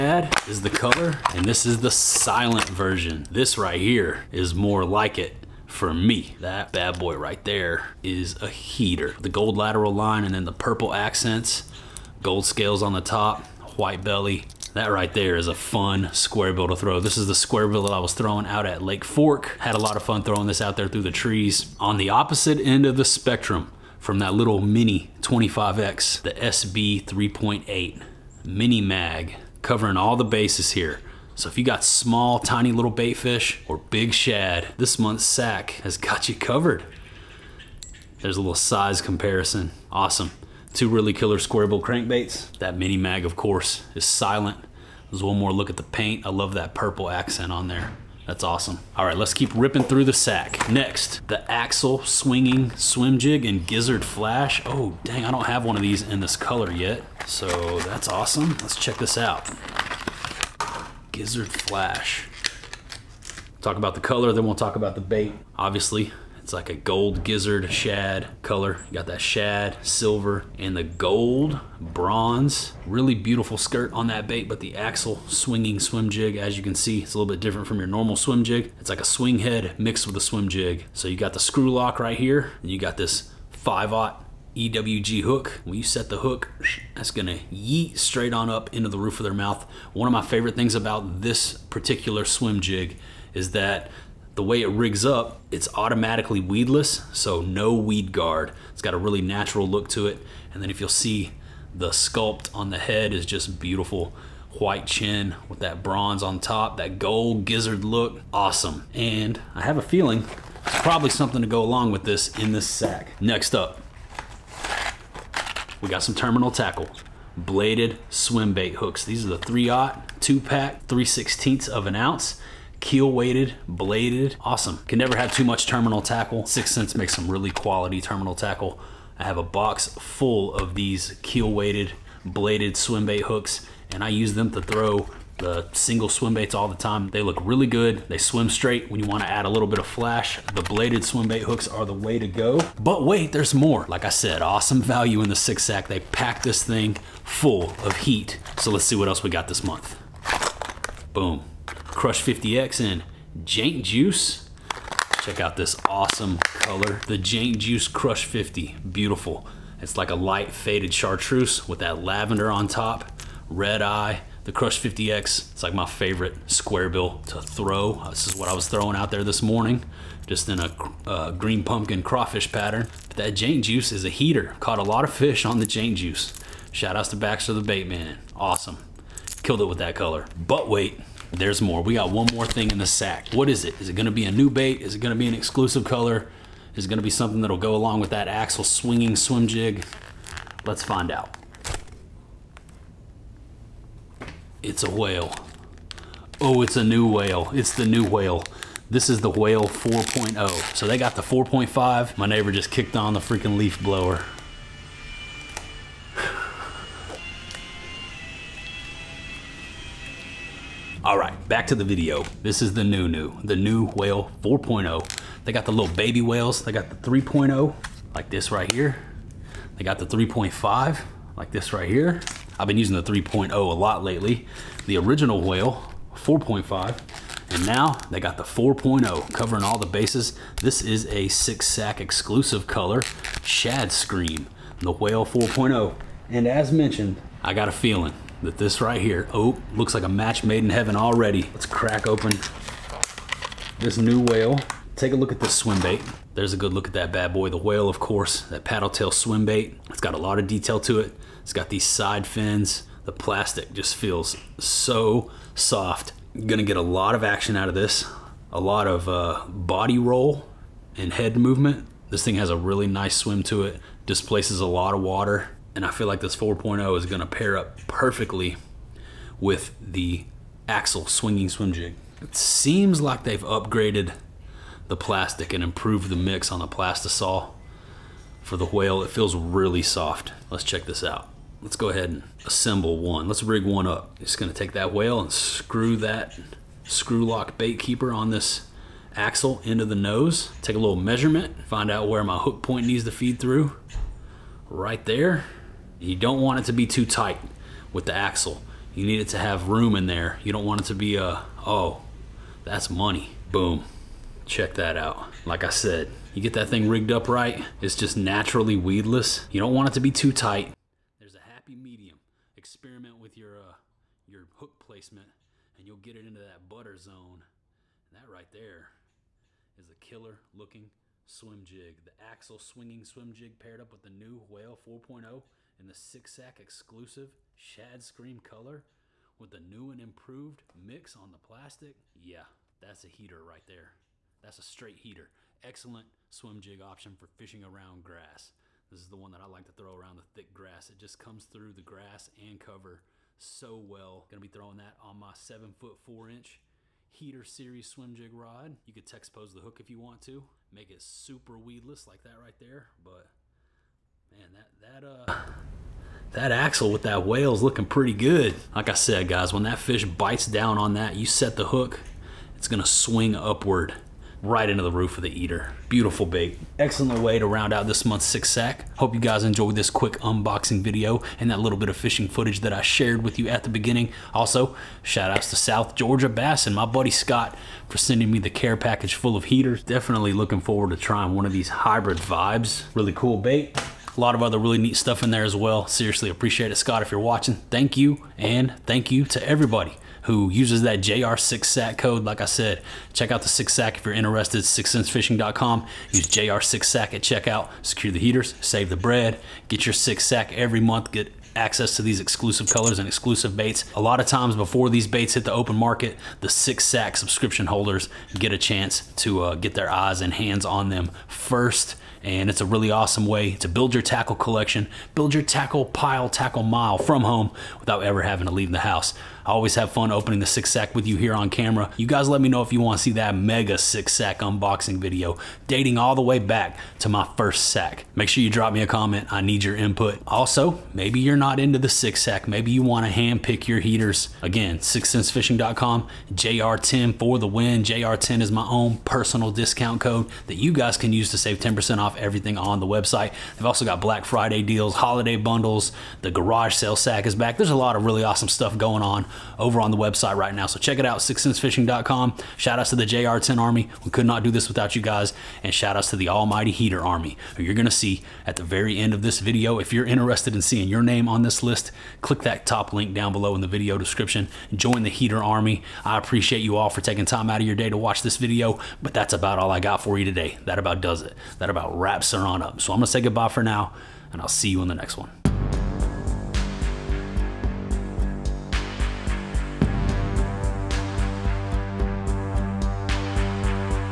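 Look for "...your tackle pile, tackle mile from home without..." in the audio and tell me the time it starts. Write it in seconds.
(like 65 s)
415 s.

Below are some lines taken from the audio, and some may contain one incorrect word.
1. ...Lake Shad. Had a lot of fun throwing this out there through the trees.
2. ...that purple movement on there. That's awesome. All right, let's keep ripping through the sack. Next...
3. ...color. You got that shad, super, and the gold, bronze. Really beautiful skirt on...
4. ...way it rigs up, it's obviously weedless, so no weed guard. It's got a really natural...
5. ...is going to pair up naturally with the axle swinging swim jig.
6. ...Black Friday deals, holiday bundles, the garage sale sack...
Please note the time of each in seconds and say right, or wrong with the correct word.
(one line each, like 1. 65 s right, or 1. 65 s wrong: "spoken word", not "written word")
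1. 18 s wrong: "Fork", not "Shad"
2. 46 s wrong: "accent", not "movement"
3. 68 s wrong: "silver", not "super"
4. 94 s wrong: "automatically", not "obviously"
5. 266 s wrong: "perfectly", not "naturally"
6. 443 s right.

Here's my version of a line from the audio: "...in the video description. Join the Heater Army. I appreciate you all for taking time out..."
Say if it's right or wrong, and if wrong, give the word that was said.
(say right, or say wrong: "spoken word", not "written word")
right.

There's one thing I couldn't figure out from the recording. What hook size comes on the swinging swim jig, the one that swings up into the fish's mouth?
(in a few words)
5-aught.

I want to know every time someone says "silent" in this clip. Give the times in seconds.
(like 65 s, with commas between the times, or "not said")
1 s, 44 s.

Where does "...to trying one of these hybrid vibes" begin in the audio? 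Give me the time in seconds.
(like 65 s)
380 s.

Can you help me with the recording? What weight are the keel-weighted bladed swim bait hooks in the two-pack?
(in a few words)
3/16 ounce.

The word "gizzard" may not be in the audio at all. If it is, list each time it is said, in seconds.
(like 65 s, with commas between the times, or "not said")
53 s, 61 s, 67 s, 107 s.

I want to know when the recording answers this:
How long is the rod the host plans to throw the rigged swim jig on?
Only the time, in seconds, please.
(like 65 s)
345 s.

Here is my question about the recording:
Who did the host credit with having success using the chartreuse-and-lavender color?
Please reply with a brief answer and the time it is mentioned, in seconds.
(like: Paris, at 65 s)
Baxter the Bait Man, at 177 s.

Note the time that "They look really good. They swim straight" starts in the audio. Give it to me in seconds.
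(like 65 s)
137 s.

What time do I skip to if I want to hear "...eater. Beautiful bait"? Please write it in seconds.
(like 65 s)
365 s.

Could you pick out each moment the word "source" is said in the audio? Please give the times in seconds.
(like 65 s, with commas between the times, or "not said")
not said.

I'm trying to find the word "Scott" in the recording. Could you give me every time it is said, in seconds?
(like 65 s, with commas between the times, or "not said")
377 s, 386 s.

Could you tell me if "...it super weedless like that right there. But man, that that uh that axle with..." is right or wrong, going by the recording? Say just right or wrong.
right.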